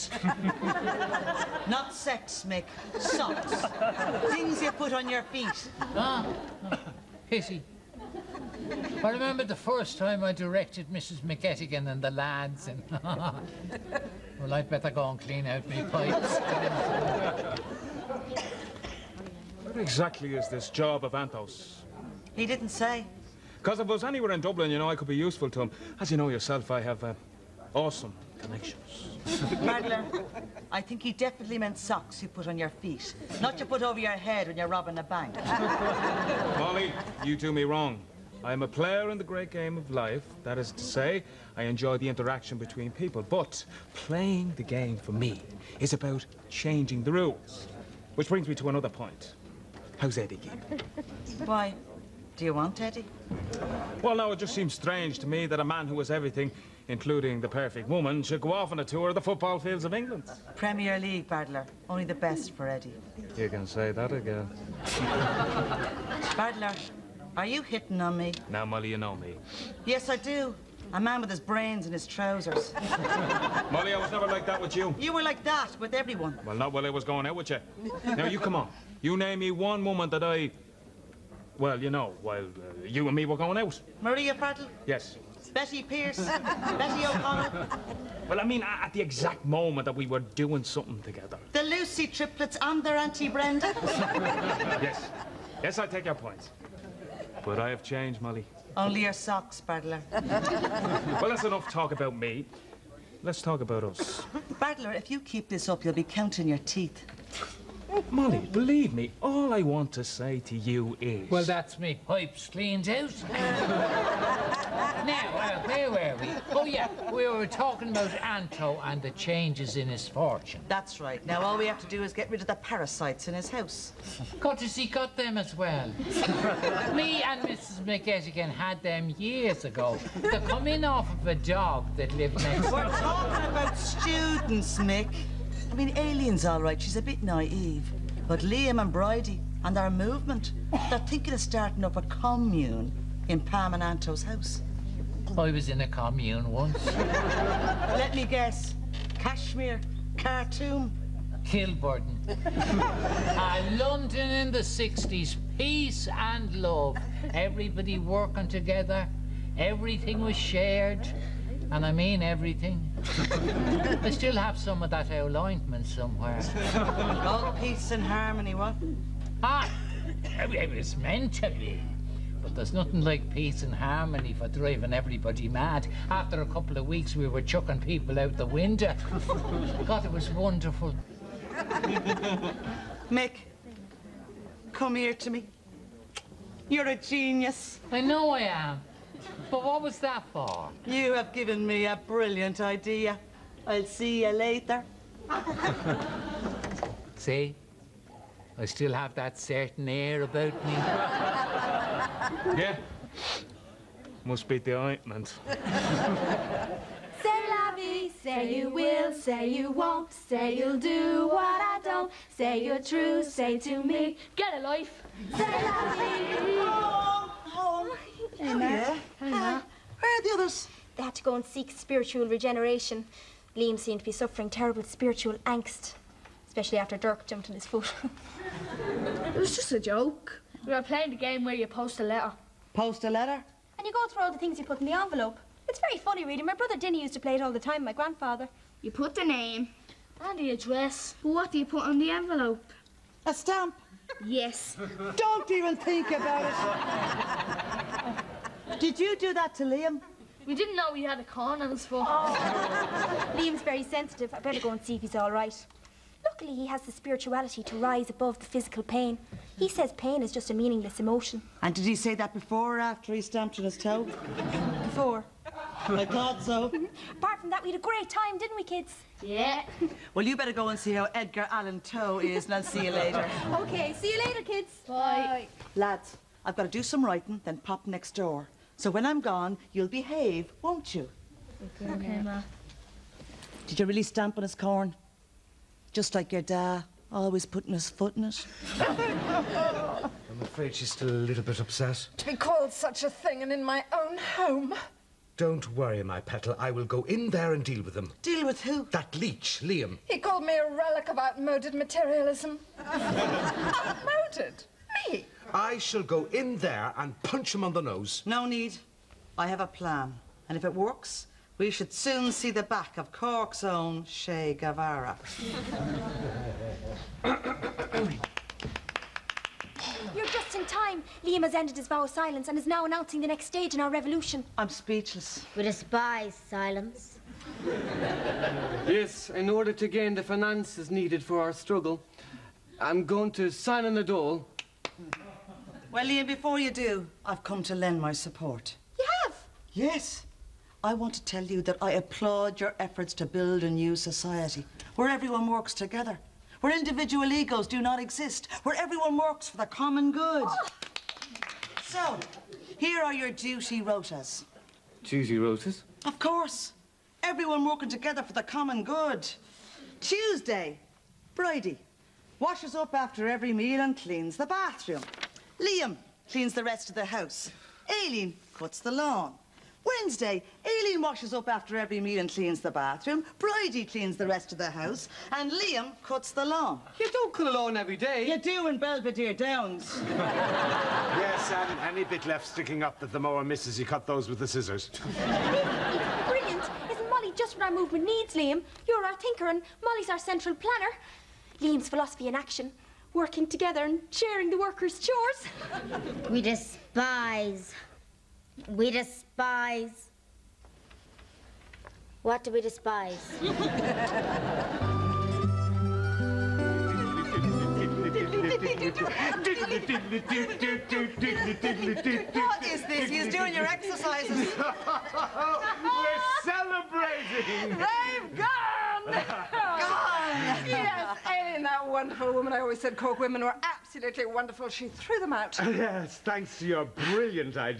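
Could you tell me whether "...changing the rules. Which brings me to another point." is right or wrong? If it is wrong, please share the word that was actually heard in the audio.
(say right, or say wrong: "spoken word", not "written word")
right.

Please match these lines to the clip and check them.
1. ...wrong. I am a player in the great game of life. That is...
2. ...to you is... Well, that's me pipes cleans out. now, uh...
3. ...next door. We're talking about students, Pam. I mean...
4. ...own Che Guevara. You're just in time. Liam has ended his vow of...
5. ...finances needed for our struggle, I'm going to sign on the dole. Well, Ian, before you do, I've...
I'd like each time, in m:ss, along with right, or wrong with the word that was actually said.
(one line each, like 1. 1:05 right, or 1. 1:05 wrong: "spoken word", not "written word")
1. 0:37 right
2. 1:50 right
3. 2:12 wrong: "Nick", not "Pam"
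4. 5:13 right
5. 5:30 right.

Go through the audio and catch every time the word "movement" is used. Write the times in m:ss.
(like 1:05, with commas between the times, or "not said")
2:19, 6:27.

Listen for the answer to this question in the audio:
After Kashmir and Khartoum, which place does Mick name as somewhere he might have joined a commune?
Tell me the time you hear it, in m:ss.
2:31.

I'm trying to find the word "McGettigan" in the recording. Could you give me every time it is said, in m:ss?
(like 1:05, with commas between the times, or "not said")
0:11, 2:07.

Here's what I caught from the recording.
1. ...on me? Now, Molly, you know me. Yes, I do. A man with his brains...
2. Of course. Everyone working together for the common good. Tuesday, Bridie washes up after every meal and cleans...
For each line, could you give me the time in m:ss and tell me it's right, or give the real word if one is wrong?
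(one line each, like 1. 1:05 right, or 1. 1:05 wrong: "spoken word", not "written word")
1. 1:08 right
2. 5:56 right.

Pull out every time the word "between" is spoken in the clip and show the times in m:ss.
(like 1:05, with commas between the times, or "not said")
0:42.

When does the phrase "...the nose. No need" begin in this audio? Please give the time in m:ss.
5:07.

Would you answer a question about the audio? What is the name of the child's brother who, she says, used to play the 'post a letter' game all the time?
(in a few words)
Dinny.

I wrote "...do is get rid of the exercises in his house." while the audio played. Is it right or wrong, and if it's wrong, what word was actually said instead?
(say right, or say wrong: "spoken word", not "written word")
wrong: "parasites", not "exercises".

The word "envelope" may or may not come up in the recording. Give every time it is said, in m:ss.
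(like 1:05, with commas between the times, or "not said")
3:54, 4:02.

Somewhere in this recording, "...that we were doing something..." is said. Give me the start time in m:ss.
1:29.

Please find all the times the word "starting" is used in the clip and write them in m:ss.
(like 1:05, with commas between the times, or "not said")
2:21.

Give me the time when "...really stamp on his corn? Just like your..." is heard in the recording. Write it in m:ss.
4:43.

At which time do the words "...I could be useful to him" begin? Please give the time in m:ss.
0:24.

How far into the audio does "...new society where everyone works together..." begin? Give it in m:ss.
5:43.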